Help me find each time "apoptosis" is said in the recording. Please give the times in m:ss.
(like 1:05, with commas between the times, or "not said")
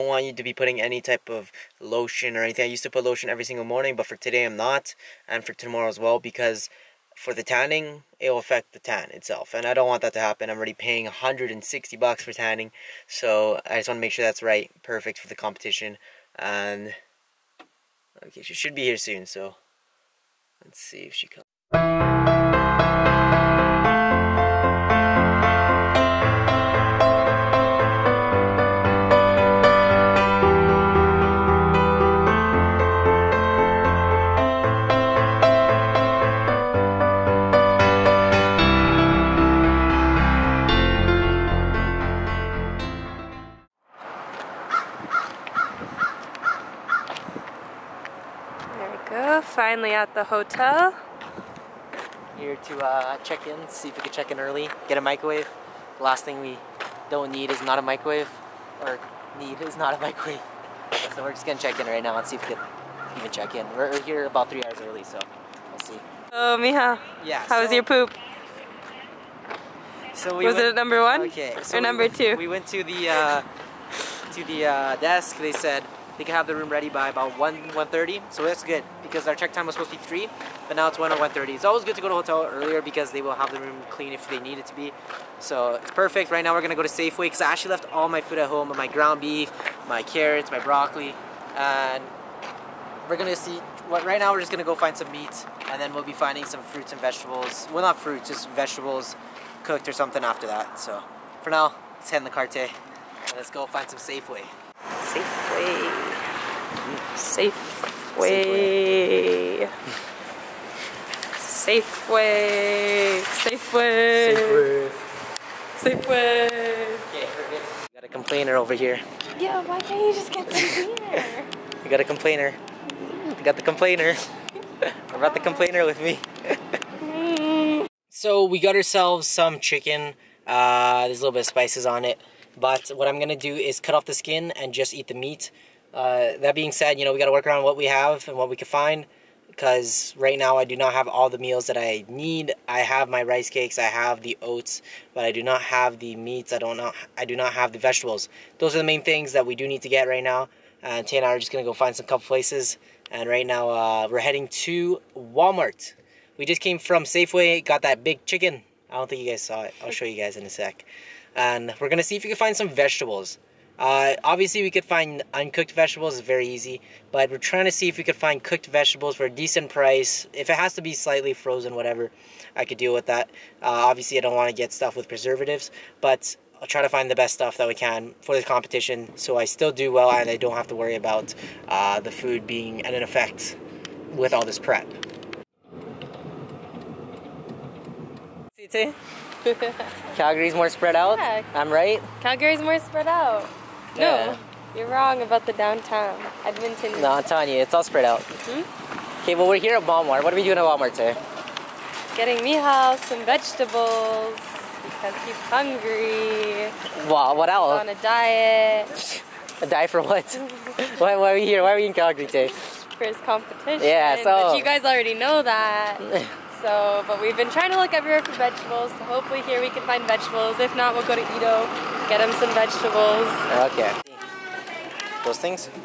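not said.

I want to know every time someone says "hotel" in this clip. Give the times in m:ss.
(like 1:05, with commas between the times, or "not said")
0:50, 1:22.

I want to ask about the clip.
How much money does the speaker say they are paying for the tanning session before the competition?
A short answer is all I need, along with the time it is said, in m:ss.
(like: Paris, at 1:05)
$160, at 0:11.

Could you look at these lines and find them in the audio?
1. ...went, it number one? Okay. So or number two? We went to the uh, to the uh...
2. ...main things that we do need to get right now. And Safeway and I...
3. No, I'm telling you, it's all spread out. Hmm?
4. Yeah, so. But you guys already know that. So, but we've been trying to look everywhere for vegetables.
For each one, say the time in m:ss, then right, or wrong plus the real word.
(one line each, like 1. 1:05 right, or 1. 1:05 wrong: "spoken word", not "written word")
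1. 1:10 right
2. 2:28 wrong: "Tay", not "Safeway"
3. 3:17 right
4. 3:33 right.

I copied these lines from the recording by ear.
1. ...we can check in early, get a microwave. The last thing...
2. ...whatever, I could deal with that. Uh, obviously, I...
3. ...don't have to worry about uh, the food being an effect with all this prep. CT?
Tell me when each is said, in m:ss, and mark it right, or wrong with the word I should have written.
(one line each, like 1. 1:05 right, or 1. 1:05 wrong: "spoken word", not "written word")
1. 0:53 right
2. 2:51 right
3. 3:00 right.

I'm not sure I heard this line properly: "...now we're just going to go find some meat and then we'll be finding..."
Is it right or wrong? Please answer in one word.
right.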